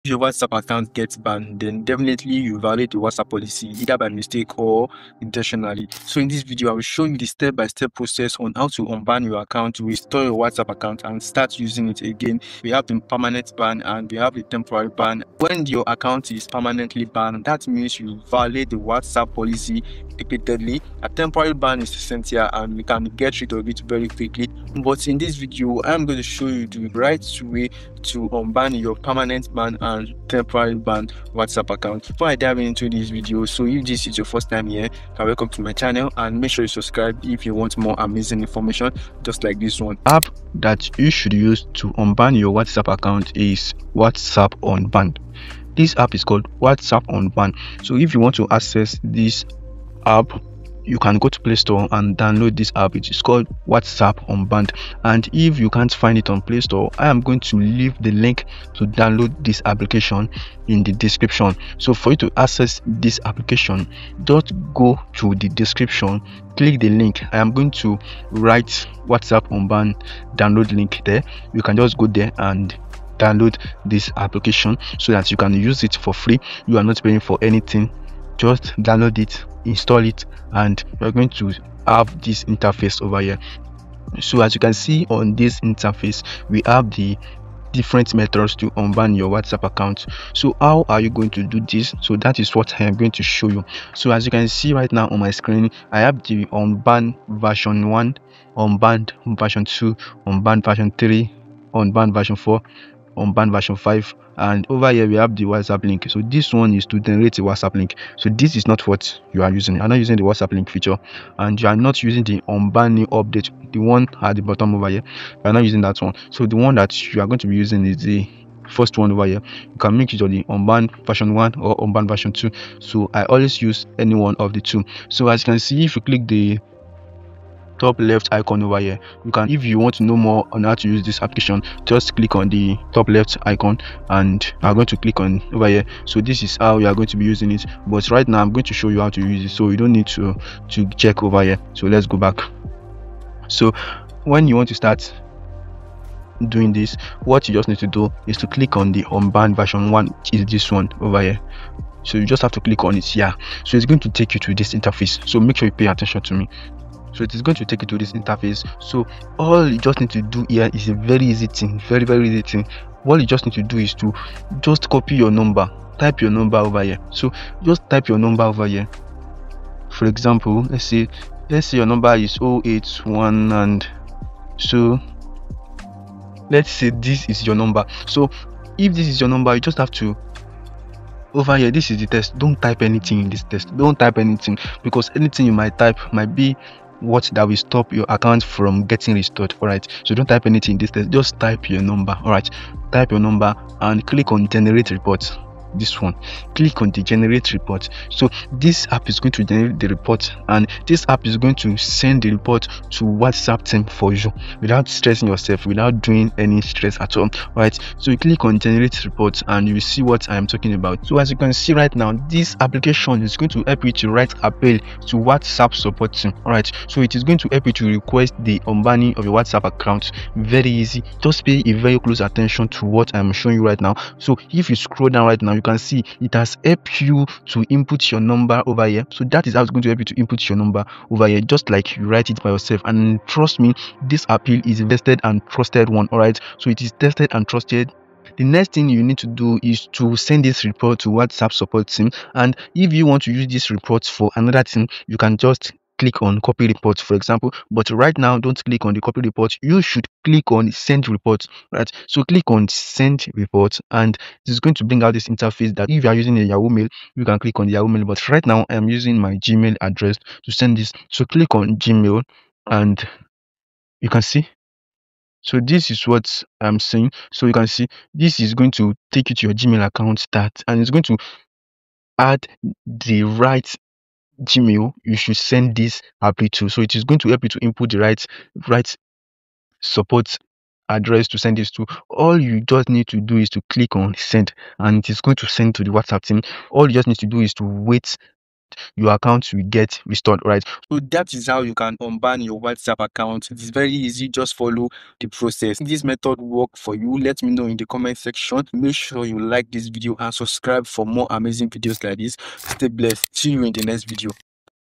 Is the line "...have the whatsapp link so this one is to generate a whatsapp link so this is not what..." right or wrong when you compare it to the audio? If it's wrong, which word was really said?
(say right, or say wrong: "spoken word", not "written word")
right.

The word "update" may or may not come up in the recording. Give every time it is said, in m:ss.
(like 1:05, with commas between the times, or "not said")
1:53.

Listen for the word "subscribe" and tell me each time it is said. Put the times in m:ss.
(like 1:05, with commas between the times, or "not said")
0:36, 5:00.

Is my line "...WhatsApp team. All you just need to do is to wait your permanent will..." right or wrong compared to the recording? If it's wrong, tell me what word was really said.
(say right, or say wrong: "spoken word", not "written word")
wrong: "account", not "permanent".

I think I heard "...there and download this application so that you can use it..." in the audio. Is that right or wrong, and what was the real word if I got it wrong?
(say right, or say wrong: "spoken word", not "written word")
right.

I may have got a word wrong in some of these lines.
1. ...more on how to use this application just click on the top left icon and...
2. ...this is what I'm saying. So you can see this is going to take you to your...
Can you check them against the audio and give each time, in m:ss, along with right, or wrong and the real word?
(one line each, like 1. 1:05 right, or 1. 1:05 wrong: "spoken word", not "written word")
1. 2:10 right
2. 4:25 right.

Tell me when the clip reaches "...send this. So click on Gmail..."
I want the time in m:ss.
4:20.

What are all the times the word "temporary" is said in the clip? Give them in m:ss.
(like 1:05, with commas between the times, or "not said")
0:14, 0:21, 0:30.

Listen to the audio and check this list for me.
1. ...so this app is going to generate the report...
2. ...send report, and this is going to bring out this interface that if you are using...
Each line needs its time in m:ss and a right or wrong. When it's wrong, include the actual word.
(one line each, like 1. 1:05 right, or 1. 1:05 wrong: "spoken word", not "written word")
1. 3:18 right
2. 4:12 right.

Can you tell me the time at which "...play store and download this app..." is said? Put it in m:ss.
0:51.